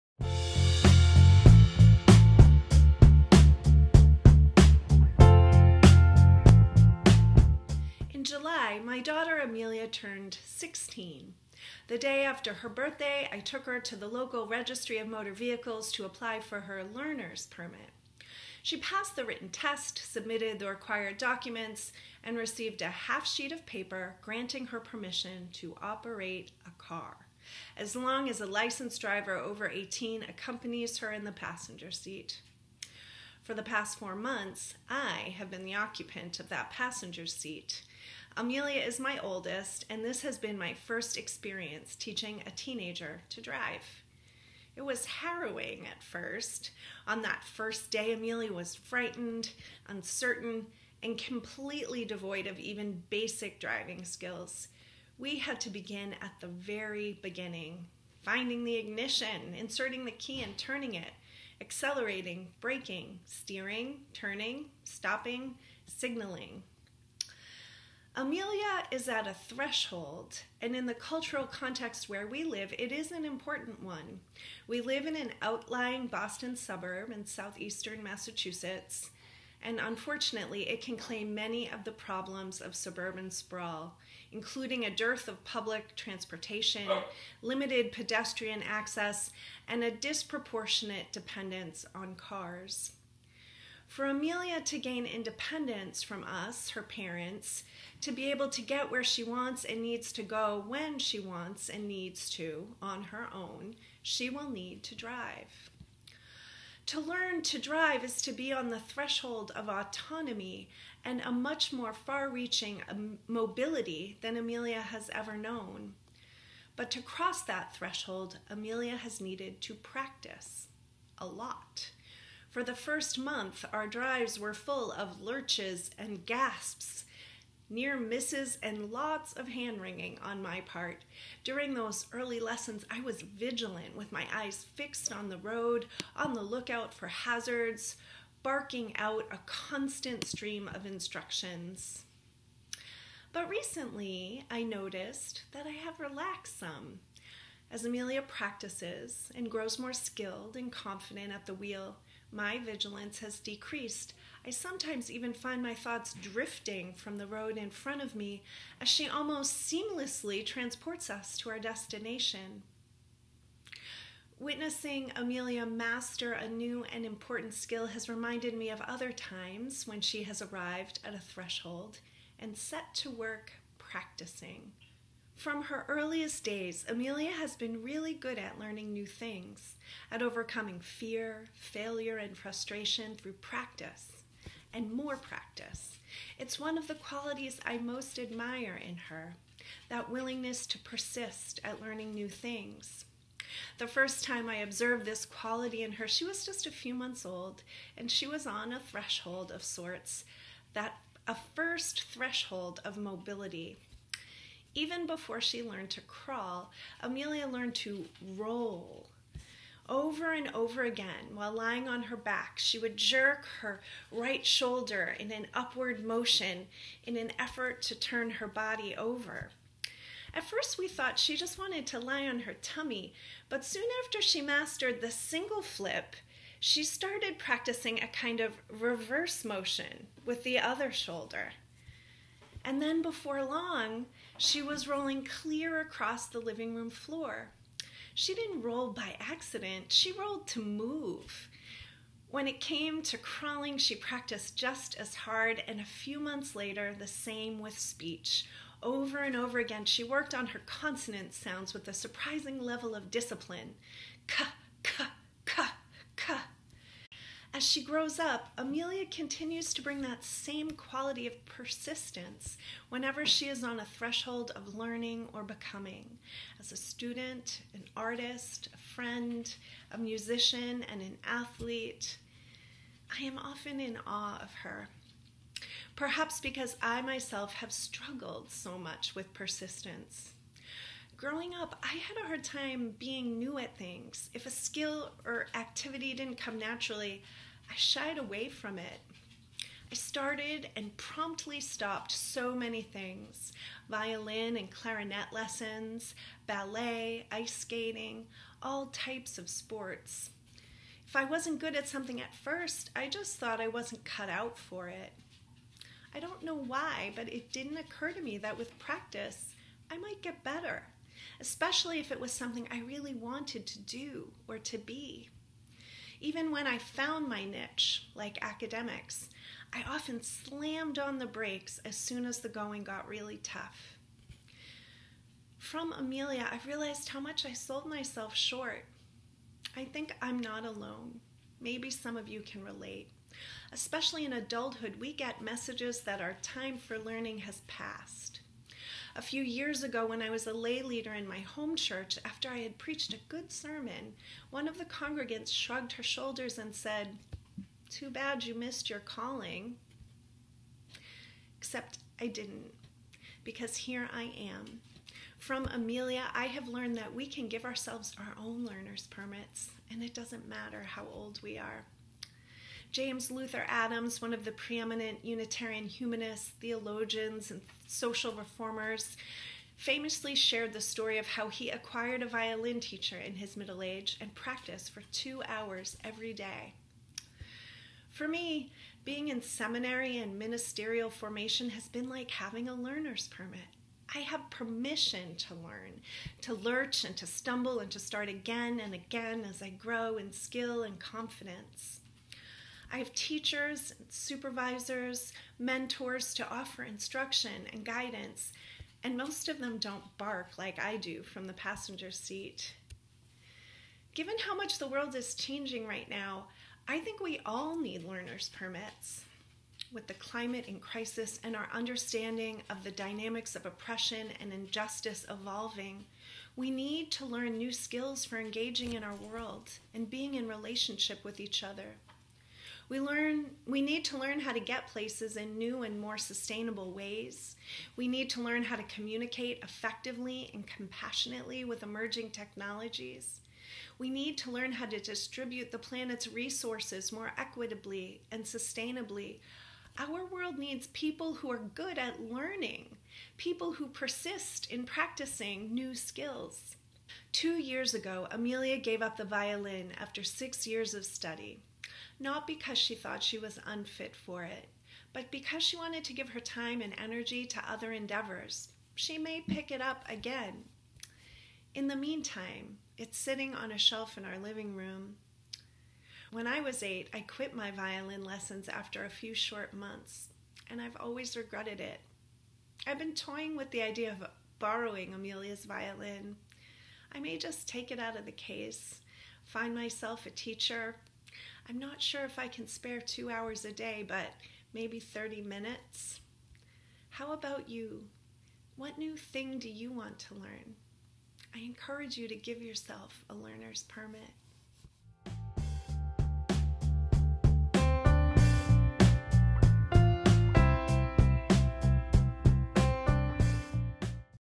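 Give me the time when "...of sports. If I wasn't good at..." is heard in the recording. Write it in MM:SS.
04:59.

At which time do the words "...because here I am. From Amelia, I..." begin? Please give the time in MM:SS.
05:53.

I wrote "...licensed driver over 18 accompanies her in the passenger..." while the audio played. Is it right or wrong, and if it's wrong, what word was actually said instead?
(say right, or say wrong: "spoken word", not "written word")
right.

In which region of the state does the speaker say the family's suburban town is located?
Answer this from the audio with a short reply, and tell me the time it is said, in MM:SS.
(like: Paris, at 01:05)
Southeastern Massachusetts, at 01:17.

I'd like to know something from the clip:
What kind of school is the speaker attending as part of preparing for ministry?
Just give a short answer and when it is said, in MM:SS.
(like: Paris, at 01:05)
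Seminary, at 06:19.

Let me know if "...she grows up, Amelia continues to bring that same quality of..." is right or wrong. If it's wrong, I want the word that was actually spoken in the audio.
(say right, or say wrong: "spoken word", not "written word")
right.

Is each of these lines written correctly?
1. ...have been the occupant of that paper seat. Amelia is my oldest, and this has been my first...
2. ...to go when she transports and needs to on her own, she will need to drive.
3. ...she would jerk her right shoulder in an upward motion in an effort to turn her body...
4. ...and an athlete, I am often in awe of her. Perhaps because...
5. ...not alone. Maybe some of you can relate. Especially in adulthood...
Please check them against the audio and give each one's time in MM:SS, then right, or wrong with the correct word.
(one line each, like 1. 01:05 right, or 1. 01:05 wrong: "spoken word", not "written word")
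1. 00:35 wrong: "passenger", not "paper"
2. 01:40 wrong: "wants", not "transports"
3. 03:32 right
4. 04:30 right
5. 05:30 right.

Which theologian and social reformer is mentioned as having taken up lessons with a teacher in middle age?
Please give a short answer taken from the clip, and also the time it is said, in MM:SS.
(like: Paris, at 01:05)
James Luther Adams, at 06:02.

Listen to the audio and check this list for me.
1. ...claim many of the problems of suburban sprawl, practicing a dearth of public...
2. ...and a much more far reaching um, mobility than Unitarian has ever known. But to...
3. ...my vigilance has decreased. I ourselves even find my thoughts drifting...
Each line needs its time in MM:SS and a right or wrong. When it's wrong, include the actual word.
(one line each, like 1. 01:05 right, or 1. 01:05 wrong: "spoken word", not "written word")
1. 01:20 wrong: "including", not "practicing"
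2. 01:51 wrong: "Amelia", not "Unitarian"
3. 02:32 wrong: "sometimes", not "ourselves".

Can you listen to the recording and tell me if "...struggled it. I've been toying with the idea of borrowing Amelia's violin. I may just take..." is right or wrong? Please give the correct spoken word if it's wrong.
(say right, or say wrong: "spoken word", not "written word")
wrong: "regretted", not "struggled".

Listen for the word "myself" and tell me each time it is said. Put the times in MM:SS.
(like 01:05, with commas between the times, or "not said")
04:37, 05:27, 07:59.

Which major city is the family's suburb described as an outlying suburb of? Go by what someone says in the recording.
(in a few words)
Boston.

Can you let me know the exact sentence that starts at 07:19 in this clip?
Our world needs people who are good at learning, people who persist in practicing new skills.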